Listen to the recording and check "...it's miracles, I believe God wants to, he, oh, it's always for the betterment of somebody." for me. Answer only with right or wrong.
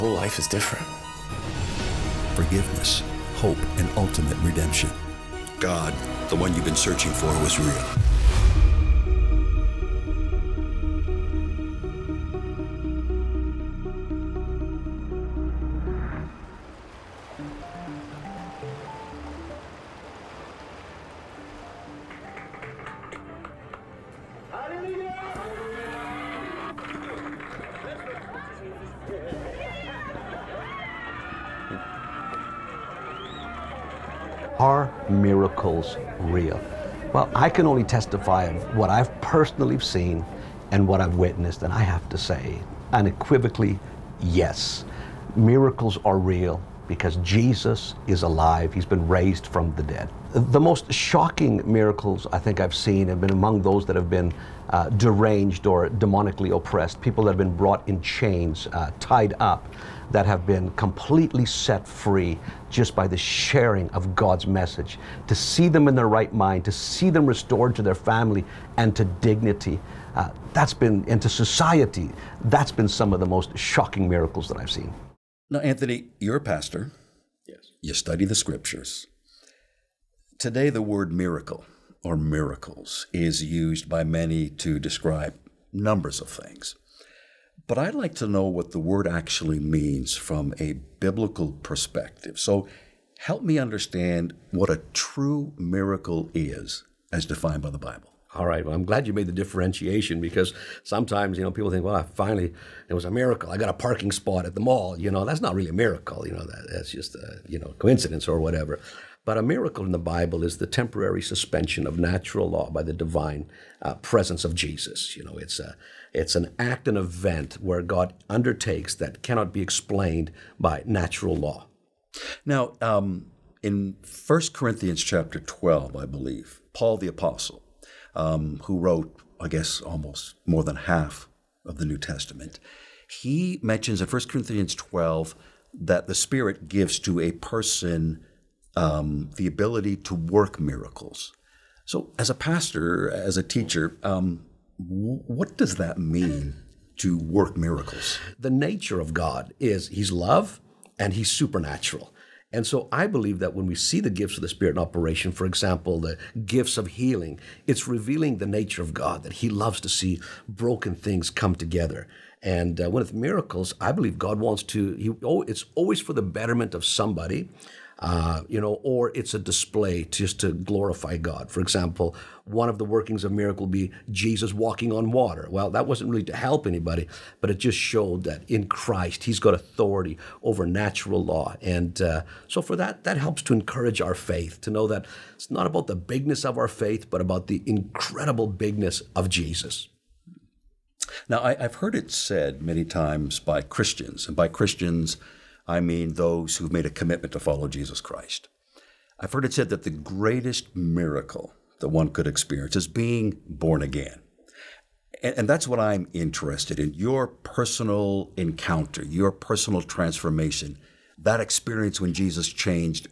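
right.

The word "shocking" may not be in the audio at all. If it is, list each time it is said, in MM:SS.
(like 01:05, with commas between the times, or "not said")
00:50, 01:13.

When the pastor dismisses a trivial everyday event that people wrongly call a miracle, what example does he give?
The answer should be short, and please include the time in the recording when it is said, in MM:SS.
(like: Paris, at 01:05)
Parking spot at the mall, at 01:43.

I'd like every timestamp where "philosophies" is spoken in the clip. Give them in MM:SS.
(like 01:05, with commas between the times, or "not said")
not said.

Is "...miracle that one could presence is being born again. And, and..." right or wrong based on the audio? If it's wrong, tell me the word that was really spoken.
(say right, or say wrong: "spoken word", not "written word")
wrong: "experience", not "presence".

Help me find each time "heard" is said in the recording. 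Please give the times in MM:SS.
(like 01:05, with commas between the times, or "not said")
03:11, 03:19.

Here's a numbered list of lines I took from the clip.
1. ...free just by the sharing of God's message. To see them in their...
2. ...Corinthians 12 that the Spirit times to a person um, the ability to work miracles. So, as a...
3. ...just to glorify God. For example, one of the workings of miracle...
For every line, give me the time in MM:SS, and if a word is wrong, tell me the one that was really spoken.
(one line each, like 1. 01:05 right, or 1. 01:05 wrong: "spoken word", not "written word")
1. 01:01 right
2. 02:14 wrong: "gives", not "times"
3. 02:50 right.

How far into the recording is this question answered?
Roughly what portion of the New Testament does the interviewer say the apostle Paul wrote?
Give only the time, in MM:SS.
02:10.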